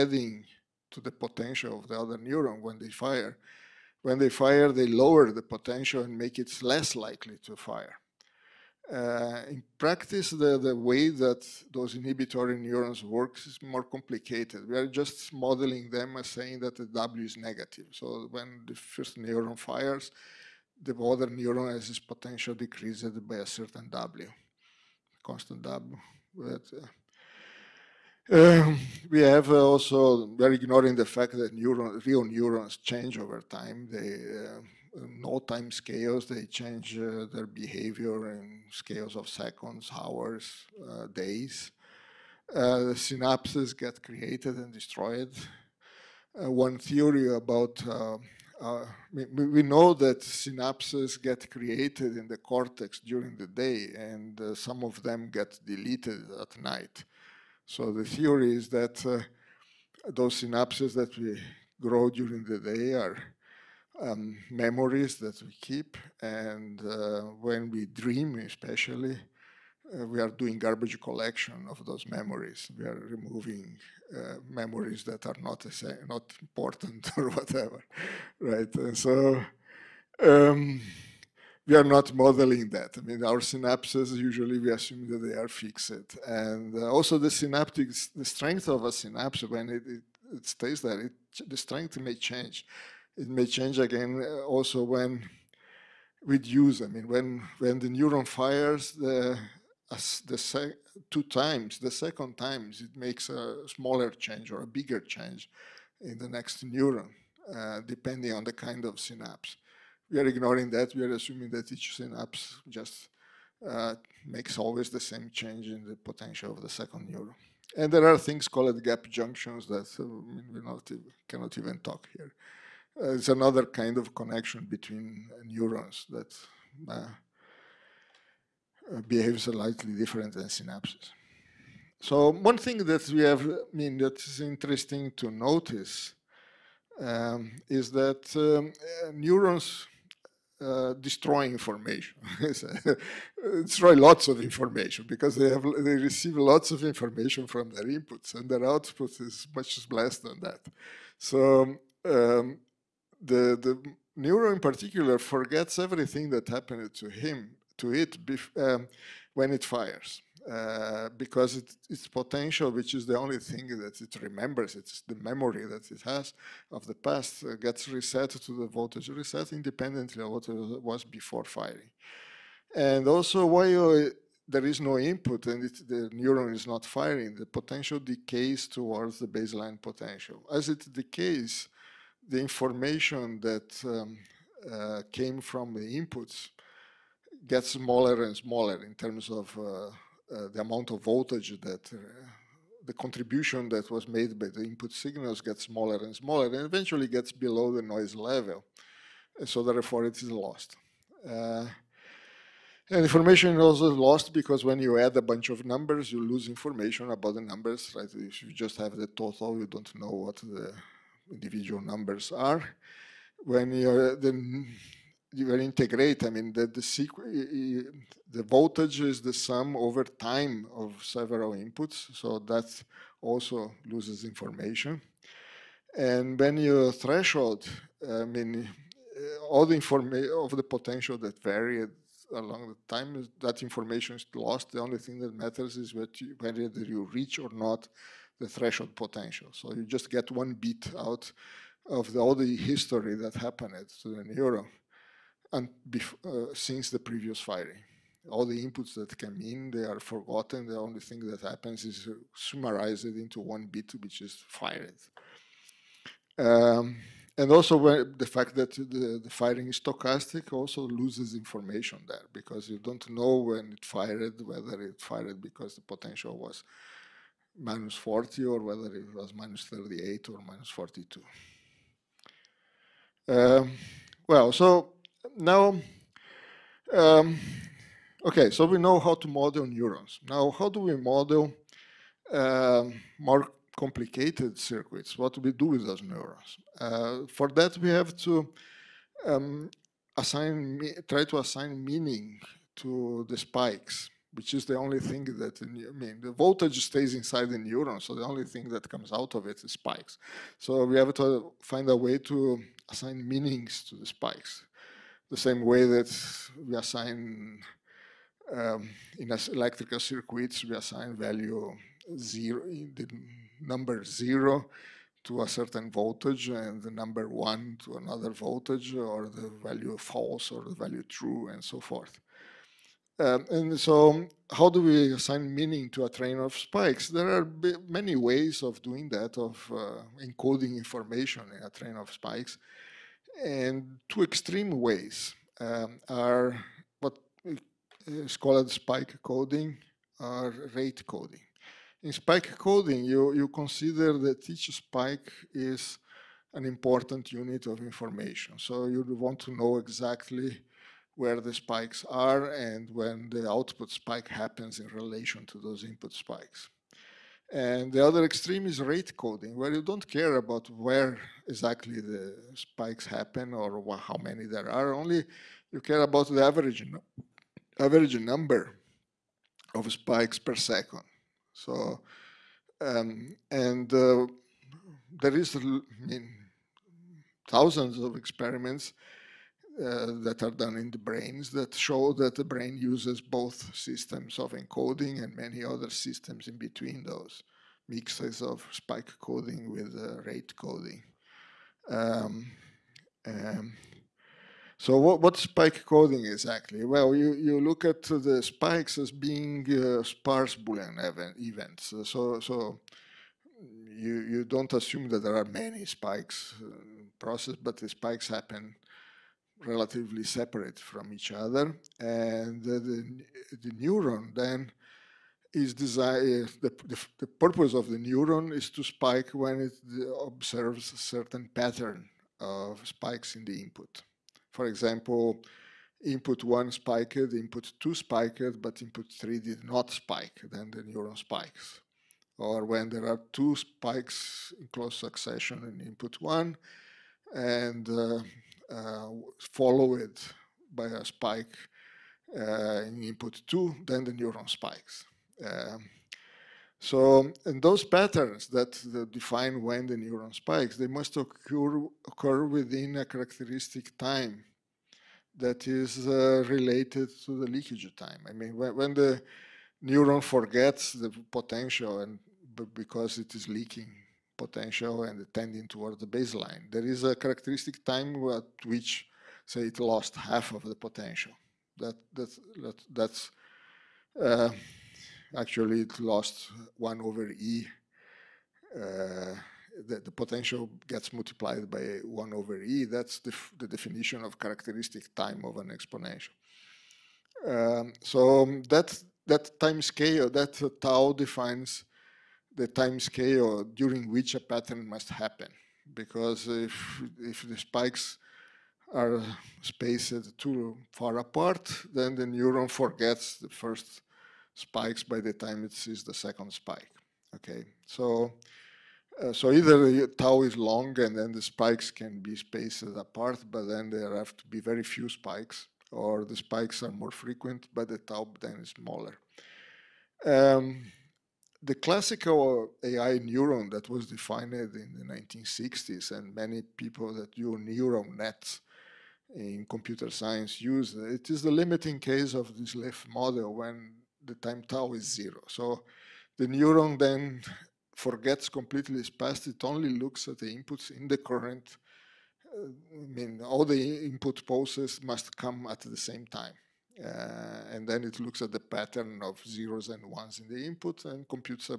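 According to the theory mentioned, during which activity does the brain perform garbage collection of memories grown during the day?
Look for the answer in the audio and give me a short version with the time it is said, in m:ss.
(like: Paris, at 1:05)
when we dream, at 1:07.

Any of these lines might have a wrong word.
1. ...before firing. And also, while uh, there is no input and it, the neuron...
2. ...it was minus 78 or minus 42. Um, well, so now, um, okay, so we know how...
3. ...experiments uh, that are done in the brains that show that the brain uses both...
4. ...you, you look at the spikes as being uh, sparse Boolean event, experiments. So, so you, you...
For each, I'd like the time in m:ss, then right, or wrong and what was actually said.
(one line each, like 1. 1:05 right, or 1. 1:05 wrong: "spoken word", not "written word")
1. 2:51 right
2. 4:28 wrong: "38", not "78"
3. 6:18 right
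4. 6:37 wrong: "events", not "experiments".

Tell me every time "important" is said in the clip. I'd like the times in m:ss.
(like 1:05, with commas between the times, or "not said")
1:16, 5:46.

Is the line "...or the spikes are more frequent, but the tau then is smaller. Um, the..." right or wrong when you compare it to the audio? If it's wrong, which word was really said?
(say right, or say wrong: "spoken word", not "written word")
right.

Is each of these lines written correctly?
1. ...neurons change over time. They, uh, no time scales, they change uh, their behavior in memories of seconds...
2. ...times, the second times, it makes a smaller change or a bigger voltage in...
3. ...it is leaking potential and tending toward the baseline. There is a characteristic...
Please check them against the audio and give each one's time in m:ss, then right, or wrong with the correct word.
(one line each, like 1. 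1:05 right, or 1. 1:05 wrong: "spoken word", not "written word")
1. 0:32 wrong: "scales", not "memories"
2. 1:41 wrong: "change", not "voltage"
3. 7:43 right.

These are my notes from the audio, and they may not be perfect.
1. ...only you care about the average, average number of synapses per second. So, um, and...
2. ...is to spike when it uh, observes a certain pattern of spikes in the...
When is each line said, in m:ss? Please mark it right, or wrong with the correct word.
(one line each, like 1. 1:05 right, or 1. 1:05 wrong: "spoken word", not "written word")
1. 6:04 wrong: "spikes", not "synapses"
2. 6:58 right.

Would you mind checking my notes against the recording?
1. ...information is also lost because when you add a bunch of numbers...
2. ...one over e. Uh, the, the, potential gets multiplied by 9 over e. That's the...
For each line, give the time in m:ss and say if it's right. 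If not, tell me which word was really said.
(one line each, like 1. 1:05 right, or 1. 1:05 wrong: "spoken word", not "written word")
1. 3:23 right
2. 7:56 wrong: "1", not "9".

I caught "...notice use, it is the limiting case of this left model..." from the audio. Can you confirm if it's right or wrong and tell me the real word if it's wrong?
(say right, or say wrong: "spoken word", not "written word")
wrong: "science", not "notice".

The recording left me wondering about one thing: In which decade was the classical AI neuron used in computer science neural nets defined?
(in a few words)
1960s.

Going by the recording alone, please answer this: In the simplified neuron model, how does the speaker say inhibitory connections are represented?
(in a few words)
W is negative.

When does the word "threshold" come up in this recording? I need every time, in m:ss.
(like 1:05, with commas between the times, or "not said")
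3:46, 3:58.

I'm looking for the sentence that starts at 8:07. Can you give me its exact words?
Um, so um, that, that time scale, that tau defines the time scale during which a pattern must happen.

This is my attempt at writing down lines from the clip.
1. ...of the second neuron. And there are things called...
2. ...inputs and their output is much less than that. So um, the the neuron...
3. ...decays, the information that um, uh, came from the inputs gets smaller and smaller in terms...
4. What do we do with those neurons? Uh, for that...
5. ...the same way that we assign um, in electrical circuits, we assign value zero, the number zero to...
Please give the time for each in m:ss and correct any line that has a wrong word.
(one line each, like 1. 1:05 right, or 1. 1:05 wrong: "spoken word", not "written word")
1. 1:56 right
2. 2:27 right
3. 3:00 right
4. 4:45 right
5. 5:05 right.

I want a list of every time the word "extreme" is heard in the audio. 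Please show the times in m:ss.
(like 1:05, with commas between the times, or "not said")
5:34, 5:58.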